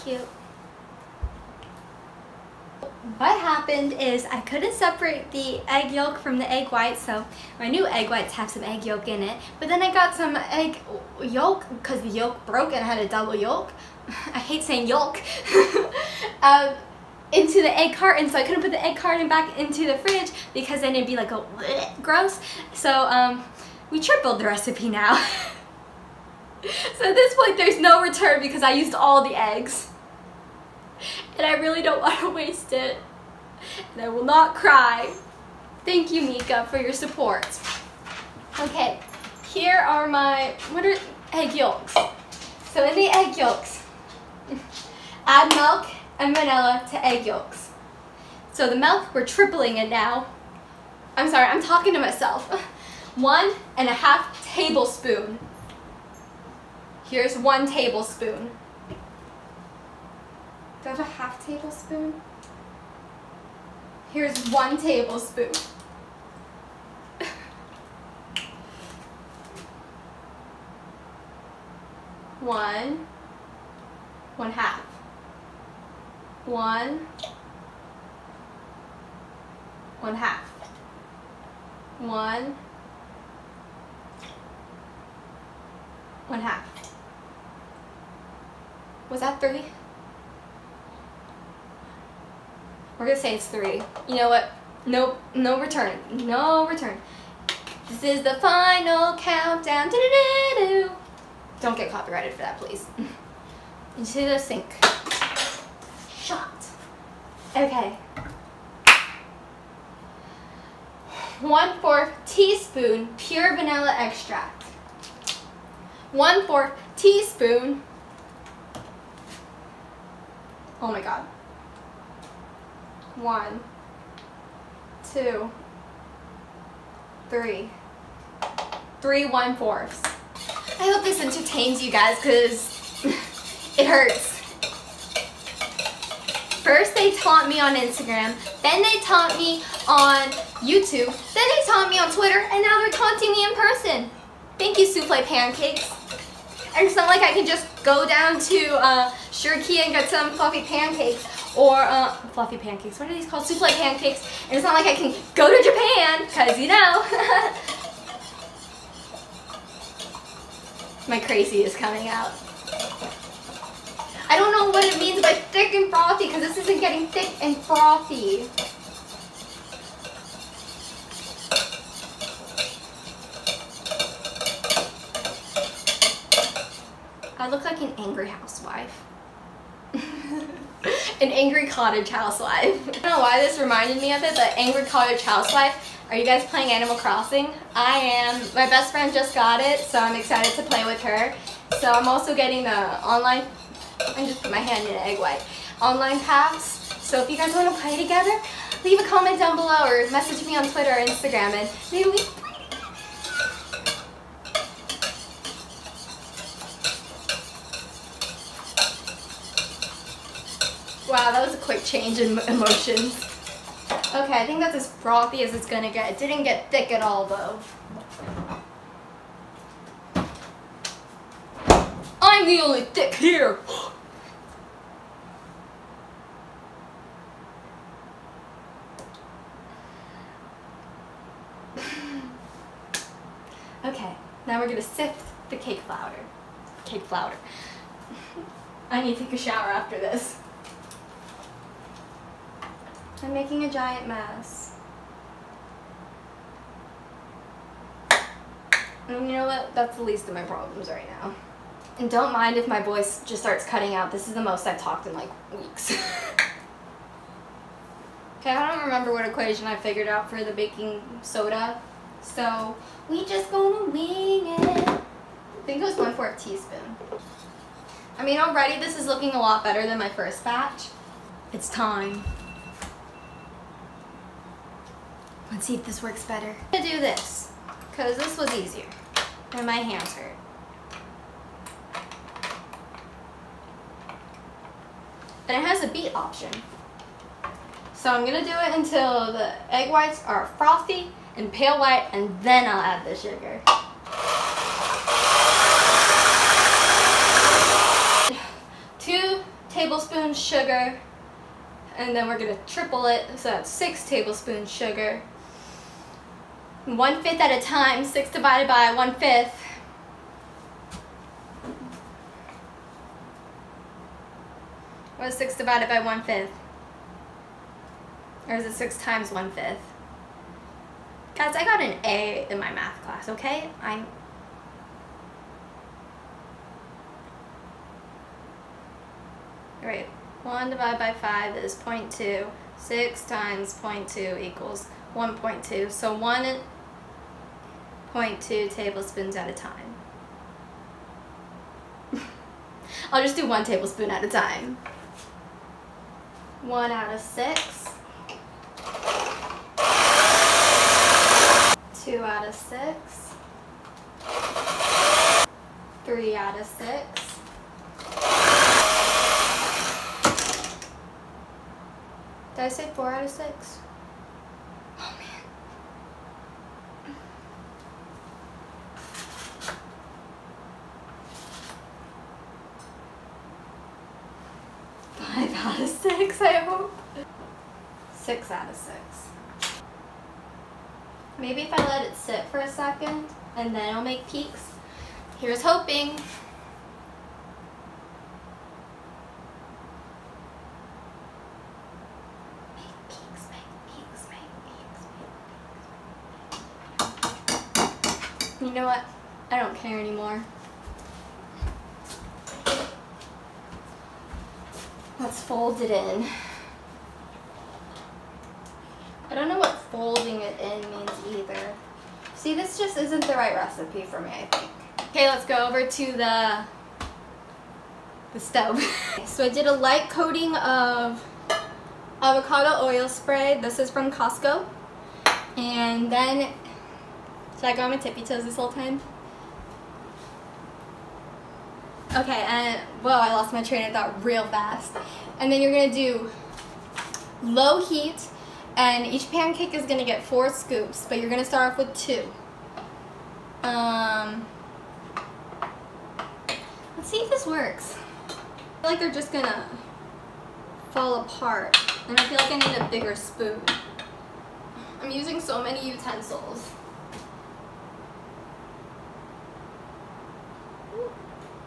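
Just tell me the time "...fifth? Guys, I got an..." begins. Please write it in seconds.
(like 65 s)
319 s.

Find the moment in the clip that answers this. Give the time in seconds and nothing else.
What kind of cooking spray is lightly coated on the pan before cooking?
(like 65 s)
422 s.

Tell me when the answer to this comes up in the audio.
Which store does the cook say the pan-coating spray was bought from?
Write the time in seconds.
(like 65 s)
424 s.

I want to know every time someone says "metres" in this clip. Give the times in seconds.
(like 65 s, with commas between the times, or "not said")
not said.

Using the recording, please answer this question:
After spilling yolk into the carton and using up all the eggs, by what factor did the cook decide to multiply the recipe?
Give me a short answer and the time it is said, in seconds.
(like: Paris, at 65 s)
tripled, at 23 s.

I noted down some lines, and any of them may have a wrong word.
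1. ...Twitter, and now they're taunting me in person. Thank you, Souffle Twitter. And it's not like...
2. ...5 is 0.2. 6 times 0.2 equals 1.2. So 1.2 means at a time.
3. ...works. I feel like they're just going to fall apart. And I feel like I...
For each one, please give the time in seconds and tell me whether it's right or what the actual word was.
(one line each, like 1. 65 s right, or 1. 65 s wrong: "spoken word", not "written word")
1. 142 s wrong: "Pancakes", not "Twitter"
2. 331 s wrong: "tablespoons", not "means"
3. 447 s right.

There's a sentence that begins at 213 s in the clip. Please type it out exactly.
Okay, I think that's as frothy as it's gonna get.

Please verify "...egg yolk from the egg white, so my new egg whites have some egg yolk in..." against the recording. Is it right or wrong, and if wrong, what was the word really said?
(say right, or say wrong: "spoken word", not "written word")
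right.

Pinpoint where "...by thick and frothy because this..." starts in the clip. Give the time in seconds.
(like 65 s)
165 s.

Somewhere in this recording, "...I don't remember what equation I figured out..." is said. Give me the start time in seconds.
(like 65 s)
258 s.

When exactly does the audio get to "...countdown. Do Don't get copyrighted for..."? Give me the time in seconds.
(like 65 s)
99 s.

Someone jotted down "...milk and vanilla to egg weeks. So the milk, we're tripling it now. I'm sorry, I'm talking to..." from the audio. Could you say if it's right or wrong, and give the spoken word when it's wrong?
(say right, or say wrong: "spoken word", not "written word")
wrong: "yolks", not "weeks".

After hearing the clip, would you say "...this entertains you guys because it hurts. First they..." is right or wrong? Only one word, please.
right.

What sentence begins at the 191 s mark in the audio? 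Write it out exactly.
So I'm also getting the online I just put my hand in an egg white.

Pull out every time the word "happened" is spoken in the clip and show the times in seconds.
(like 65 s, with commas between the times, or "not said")
3 s.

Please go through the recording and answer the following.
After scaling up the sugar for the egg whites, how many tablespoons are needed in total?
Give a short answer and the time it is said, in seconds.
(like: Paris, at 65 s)
6 tablespoons, at 303 s.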